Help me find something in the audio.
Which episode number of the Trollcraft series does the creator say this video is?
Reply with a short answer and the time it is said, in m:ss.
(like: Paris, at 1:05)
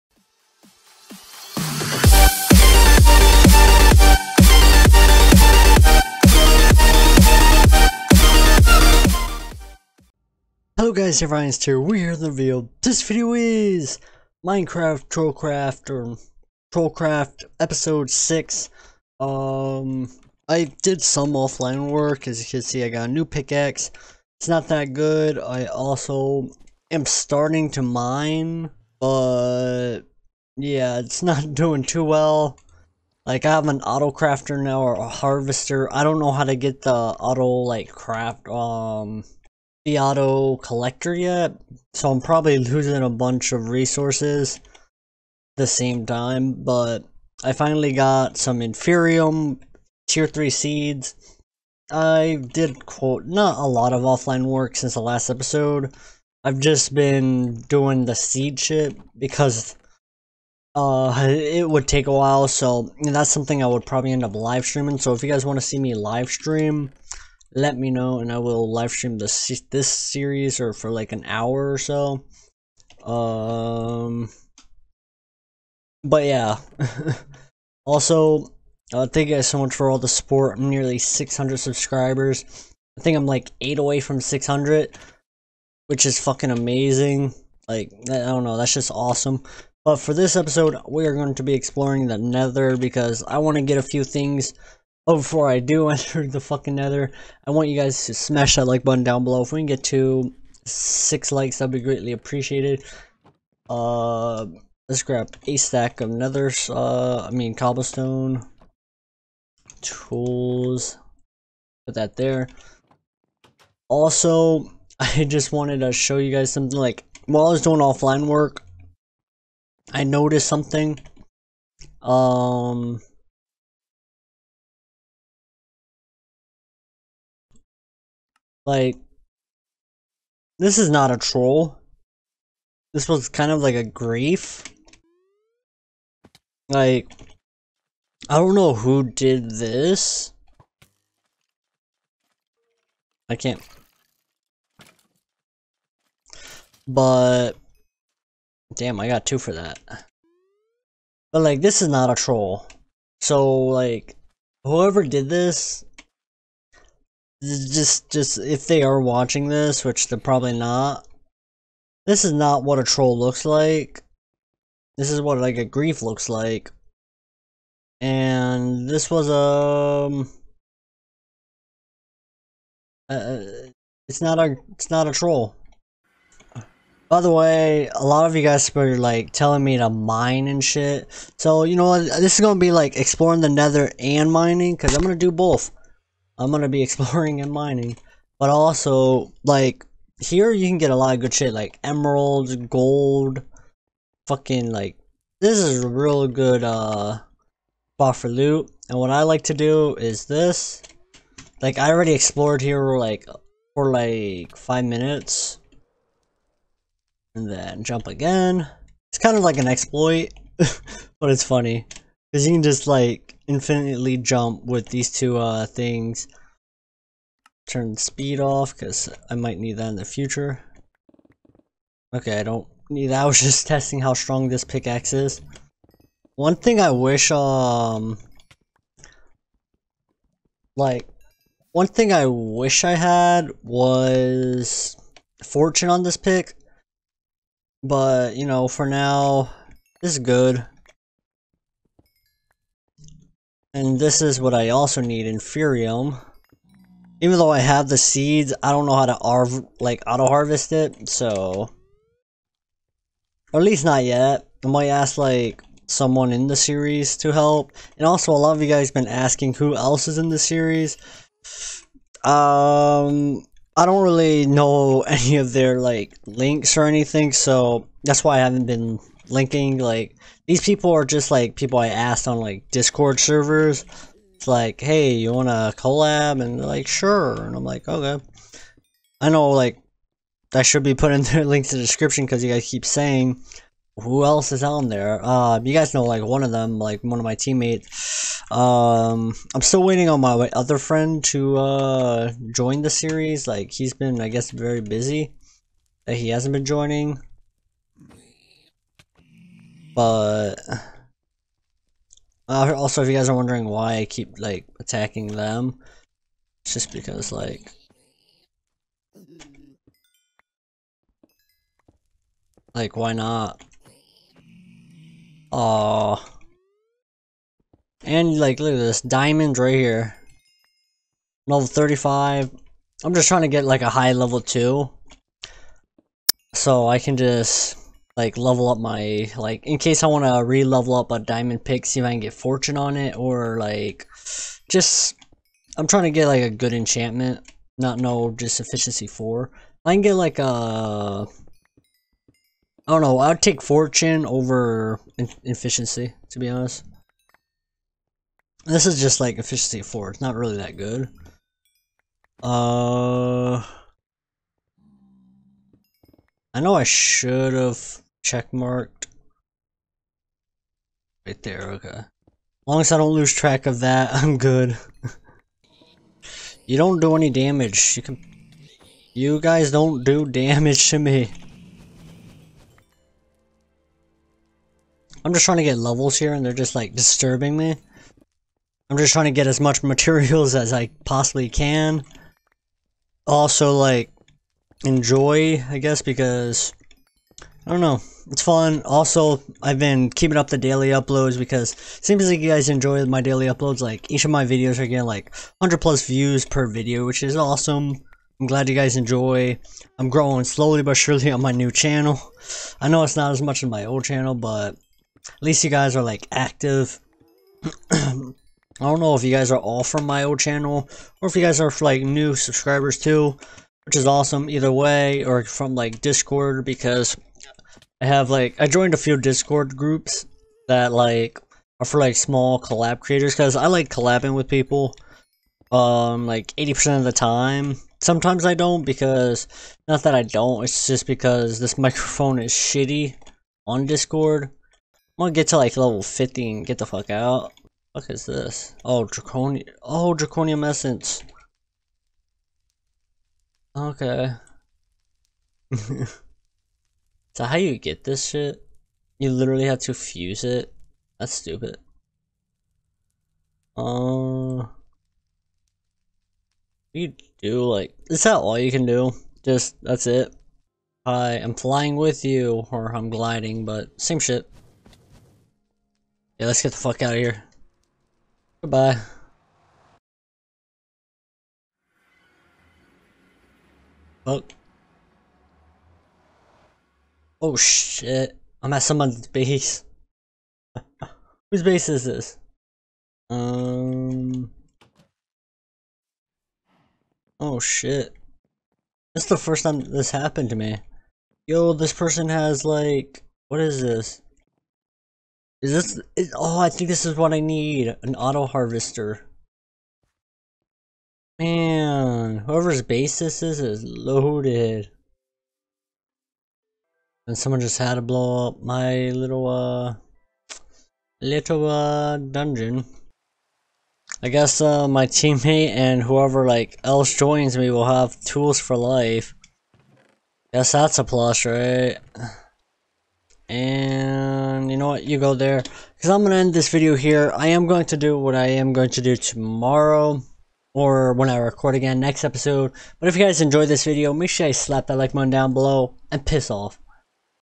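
6, at 0:17.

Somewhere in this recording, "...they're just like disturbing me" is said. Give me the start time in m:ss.
6:16.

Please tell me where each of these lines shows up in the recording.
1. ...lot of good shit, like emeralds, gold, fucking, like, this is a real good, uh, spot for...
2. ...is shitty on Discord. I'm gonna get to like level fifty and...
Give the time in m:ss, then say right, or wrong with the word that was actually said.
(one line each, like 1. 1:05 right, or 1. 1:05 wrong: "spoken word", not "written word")
1. 3:10 right
2. 7:12 right.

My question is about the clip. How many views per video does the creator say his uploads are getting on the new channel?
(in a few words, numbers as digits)
100 plus.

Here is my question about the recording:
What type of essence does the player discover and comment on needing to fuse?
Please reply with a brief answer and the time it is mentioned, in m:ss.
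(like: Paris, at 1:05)
draconium essence, at 7:20.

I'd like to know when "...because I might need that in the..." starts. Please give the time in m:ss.
3:38.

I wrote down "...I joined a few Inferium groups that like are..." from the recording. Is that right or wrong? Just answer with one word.
wrong.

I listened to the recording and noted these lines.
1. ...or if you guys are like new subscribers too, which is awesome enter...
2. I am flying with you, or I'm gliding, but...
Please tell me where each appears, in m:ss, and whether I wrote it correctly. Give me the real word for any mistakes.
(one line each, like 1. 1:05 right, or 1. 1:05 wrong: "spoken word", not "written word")
1. 6:51 wrong: "either", not "enter"
2. 7:41 right.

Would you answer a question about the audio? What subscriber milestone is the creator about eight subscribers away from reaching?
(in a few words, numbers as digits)
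600.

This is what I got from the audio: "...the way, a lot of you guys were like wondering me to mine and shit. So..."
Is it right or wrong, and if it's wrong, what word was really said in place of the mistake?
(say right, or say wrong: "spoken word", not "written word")
wrong: "telling", not "wondering".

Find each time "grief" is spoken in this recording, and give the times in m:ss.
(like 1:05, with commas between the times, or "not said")
2:13, 2:45.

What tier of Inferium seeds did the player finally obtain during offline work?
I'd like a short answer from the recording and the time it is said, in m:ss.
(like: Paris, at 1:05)
tier 3, at 0:48.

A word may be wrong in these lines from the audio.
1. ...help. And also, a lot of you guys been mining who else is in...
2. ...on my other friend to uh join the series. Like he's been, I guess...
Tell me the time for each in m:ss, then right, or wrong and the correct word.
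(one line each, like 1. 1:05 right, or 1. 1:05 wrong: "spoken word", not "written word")
1. 4:17 wrong: "asking", not "mining"
2. 4:50 right.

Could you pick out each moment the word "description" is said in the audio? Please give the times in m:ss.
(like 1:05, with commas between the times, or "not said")
4:41.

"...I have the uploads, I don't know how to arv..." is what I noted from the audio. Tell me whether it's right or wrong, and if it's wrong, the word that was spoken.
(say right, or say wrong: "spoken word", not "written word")
wrong: "seeds", not "uploads".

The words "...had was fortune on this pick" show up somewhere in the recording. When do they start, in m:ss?
3:52.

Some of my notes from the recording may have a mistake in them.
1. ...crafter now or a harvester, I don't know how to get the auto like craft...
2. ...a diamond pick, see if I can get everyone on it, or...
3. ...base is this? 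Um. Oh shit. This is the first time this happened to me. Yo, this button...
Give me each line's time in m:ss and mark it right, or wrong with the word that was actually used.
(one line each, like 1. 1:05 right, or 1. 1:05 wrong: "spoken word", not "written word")
1. 0:34 right
2. 5:31 wrong: "fortune", not "everyone"
3. 8:01 wrong: "person", not "button".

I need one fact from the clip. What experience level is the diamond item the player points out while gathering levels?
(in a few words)
35.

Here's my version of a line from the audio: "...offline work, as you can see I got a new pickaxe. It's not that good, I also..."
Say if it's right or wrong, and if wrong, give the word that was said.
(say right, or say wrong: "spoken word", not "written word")
right.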